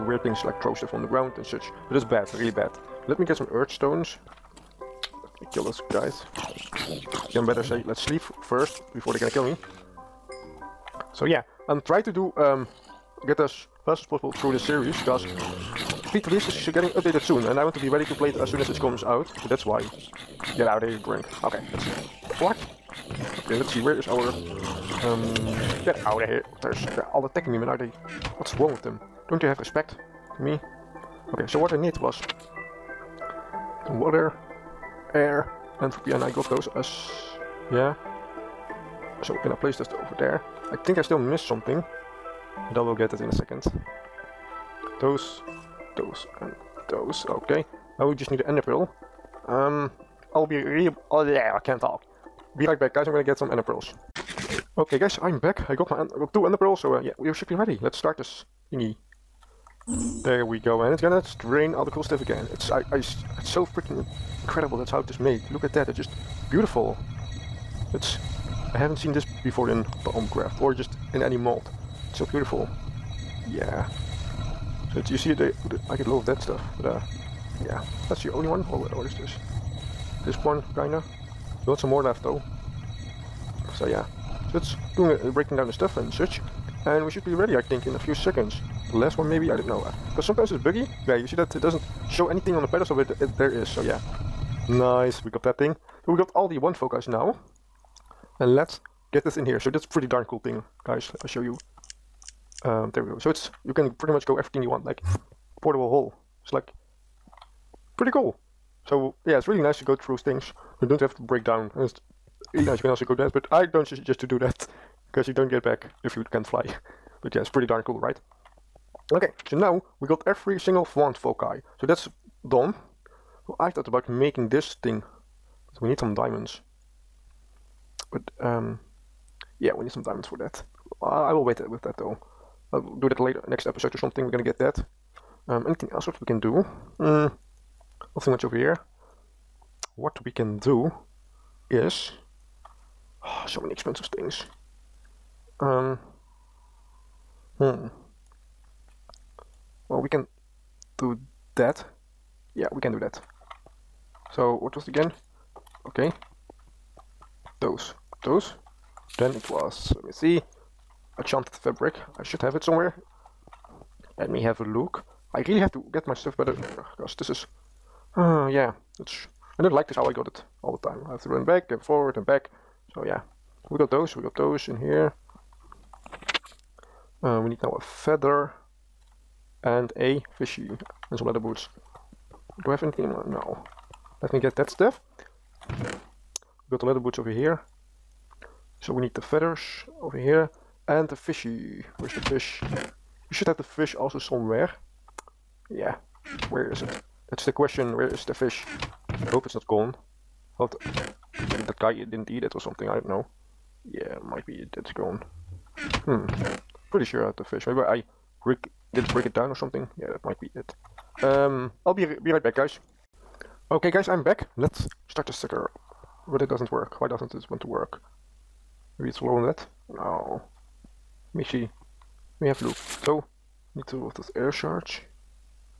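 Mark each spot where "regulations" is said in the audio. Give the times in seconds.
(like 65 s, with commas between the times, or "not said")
not said.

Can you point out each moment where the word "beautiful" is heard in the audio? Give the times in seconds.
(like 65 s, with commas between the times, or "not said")
66 s, 72 s.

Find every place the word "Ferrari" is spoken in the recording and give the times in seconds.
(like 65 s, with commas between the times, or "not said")
not said.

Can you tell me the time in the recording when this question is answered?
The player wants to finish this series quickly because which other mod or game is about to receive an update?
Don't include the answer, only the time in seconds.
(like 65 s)
16 s.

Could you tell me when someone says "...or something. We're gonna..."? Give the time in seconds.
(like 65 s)
133 s.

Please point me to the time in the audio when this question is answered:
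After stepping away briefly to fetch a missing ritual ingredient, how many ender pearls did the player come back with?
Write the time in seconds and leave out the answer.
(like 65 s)
56 s.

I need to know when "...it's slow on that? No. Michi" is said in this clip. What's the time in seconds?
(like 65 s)
219 s.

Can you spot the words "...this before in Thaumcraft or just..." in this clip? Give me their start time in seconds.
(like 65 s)
69 s.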